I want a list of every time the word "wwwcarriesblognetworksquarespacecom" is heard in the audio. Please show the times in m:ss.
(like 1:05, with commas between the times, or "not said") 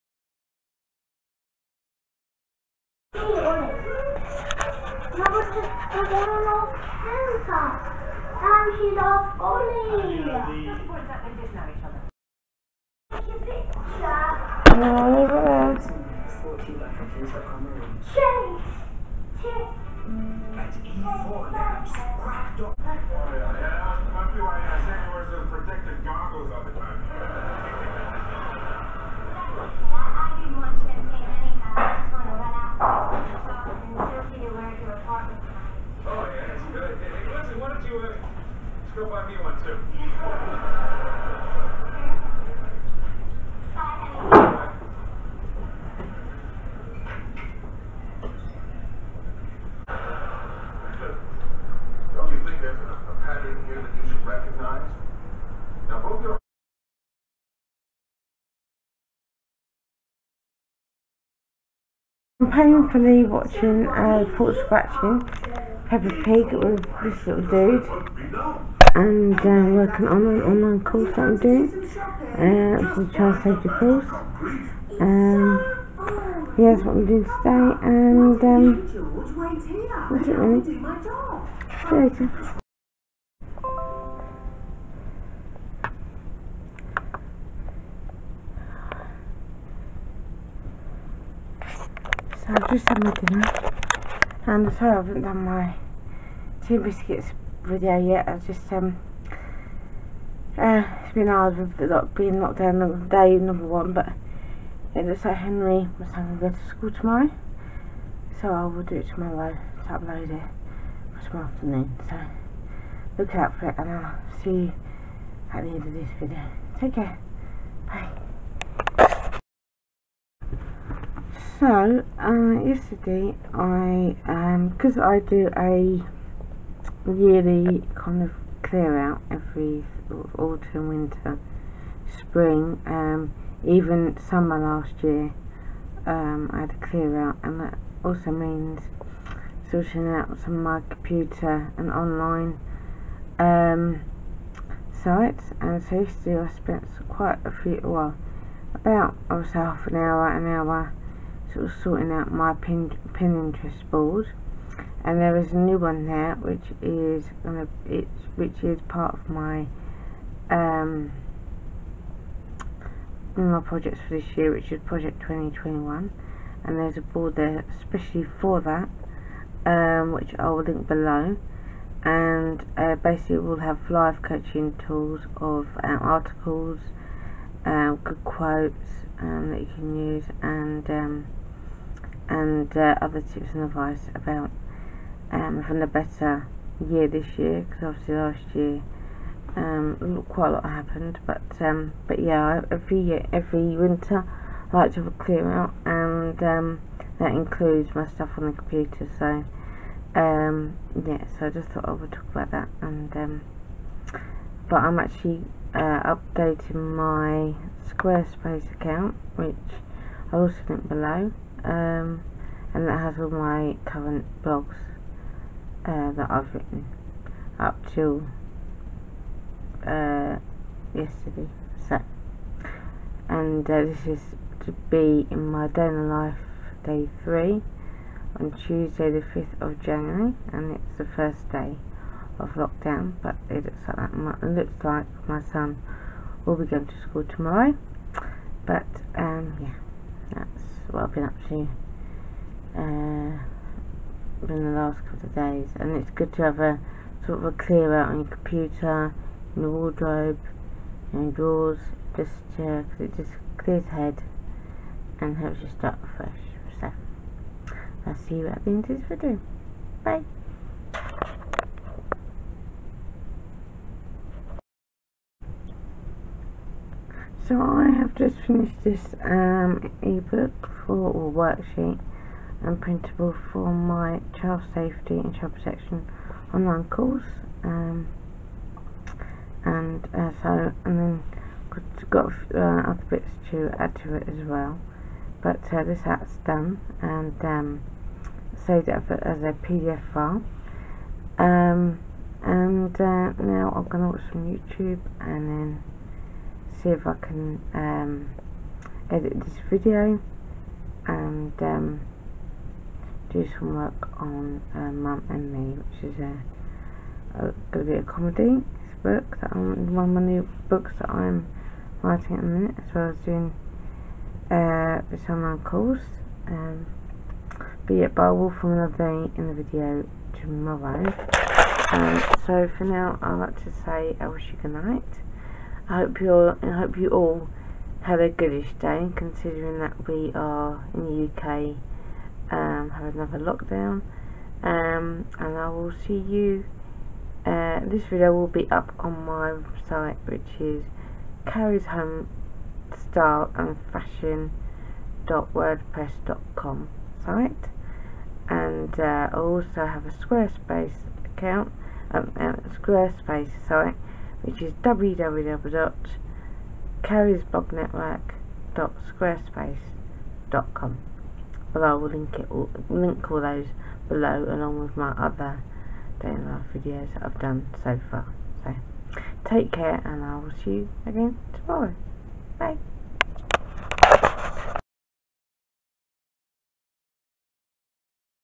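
5:54.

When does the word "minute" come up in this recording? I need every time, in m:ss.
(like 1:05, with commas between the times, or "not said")
5:12.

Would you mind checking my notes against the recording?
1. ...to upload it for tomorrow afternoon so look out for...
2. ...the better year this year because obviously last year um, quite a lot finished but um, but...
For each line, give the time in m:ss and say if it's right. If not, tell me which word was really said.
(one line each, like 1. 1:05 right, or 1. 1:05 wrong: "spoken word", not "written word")
1. 1:49 right
2. 3:05 wrong: "happened", not "finished".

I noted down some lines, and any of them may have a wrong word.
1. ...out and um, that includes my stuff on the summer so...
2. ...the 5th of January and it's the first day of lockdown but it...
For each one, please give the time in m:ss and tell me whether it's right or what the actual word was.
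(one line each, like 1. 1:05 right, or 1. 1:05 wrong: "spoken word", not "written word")
1. 3:15 wrong: "computer", not "summer"
2. 3:49 right.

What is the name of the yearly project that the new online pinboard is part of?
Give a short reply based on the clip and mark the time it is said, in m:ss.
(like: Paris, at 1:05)
project 2021, at 2:44.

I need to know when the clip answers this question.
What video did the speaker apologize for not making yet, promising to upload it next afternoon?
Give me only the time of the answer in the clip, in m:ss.
1:36.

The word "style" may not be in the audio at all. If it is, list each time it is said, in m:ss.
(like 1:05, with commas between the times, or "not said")
5:42.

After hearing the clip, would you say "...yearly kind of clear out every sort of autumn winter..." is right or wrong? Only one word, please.
right.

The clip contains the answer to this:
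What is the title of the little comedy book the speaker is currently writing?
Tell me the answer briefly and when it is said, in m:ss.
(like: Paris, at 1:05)
Mum and Me, at 5:04.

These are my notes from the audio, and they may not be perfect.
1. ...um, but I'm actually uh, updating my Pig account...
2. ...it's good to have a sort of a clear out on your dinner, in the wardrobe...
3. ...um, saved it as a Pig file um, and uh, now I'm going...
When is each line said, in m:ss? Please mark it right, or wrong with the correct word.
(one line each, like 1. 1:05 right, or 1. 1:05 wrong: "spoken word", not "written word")
1. 3:23 wrong: "Squarespace", not "Pig"
2. 4:05 wrong: "computer", not "dinner"
3. 4:47 wrong: "PDF", not "Pig".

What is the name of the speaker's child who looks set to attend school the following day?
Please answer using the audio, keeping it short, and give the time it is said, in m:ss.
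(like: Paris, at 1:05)
Henry, at 1:45.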